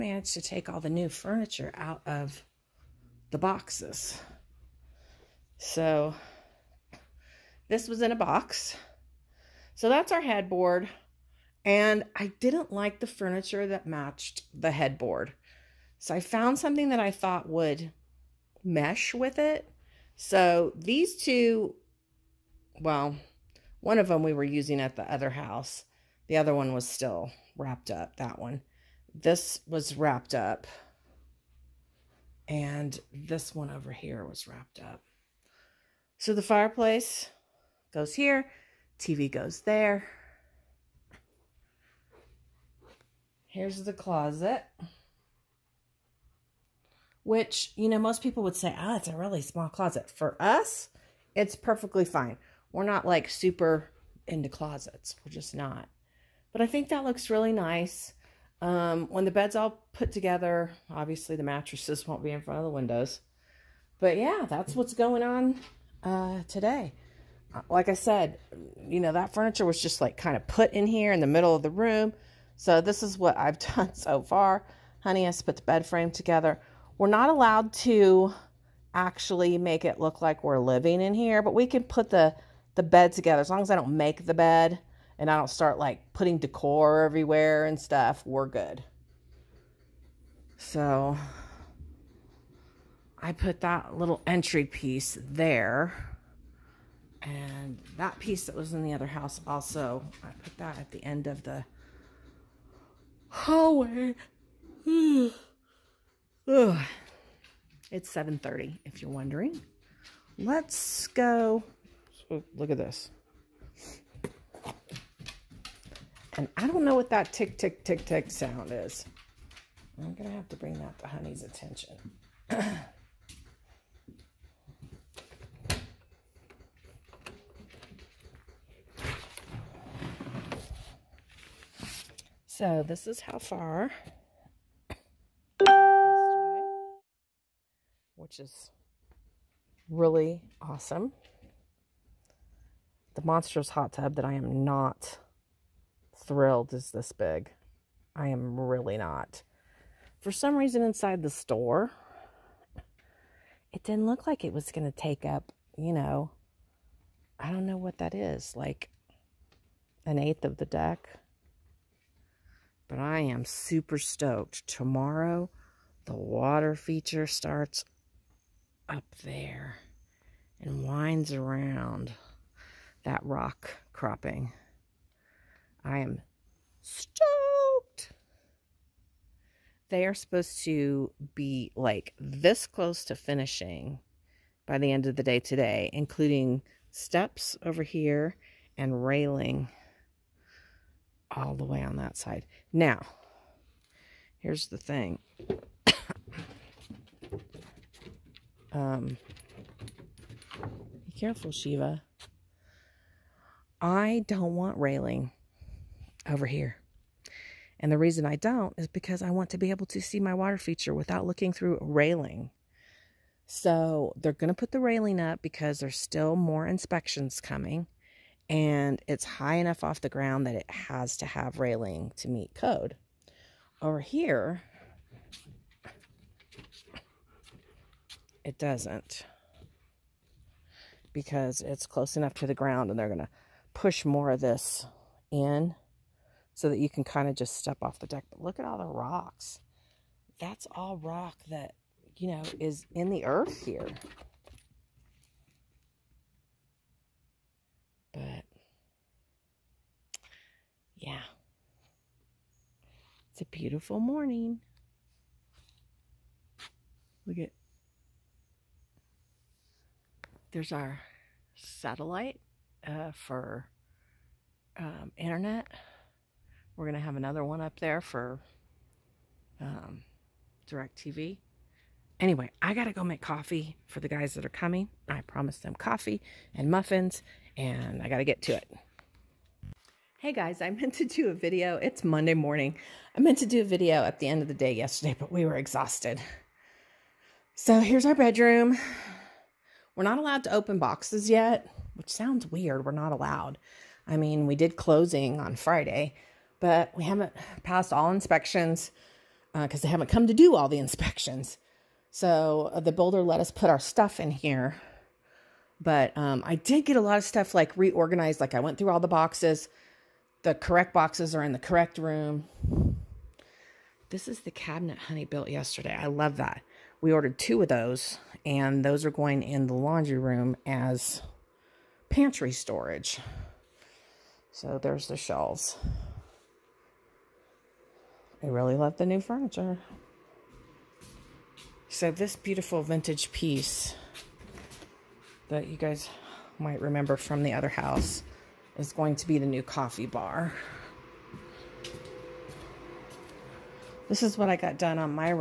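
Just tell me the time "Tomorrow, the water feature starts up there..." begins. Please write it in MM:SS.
02:44.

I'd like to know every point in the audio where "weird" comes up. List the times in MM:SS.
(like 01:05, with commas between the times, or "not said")
04:52.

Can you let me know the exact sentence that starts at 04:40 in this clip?
Hey guys, I meant to do a video.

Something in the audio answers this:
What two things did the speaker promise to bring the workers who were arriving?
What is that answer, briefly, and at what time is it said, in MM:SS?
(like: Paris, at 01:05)
coffee and muffins, at 04:35.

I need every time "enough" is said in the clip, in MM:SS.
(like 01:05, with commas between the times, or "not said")
03:39, 03:52.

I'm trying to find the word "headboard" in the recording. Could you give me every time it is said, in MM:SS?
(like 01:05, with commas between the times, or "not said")
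00:10, 00:14.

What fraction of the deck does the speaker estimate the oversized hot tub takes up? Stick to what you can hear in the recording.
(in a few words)
an eighth.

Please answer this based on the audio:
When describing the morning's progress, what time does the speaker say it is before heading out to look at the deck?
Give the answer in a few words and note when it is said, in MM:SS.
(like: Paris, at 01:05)
7:30, at 01:48.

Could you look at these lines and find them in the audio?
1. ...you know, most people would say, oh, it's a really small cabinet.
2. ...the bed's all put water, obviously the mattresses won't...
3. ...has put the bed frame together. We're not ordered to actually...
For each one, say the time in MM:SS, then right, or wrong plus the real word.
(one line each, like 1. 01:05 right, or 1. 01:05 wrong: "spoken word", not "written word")
1. 00:47 wrong: "closet", not "cabinet"
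2. 00:59 wrong: "together", not "water"
3. 01:15 wrong: "allowed", not "ordered".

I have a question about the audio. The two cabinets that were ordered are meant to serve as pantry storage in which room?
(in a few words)
laundry room.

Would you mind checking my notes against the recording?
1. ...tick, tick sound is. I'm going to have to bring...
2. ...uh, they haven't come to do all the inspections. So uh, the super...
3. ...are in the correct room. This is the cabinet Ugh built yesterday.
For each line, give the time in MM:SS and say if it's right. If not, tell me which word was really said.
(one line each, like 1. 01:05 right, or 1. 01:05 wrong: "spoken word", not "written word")
1. 01:57 right
2. 04:59 wrong: "builder", not "super"
3. 05:11 wrong: "Honey", not "Ugh".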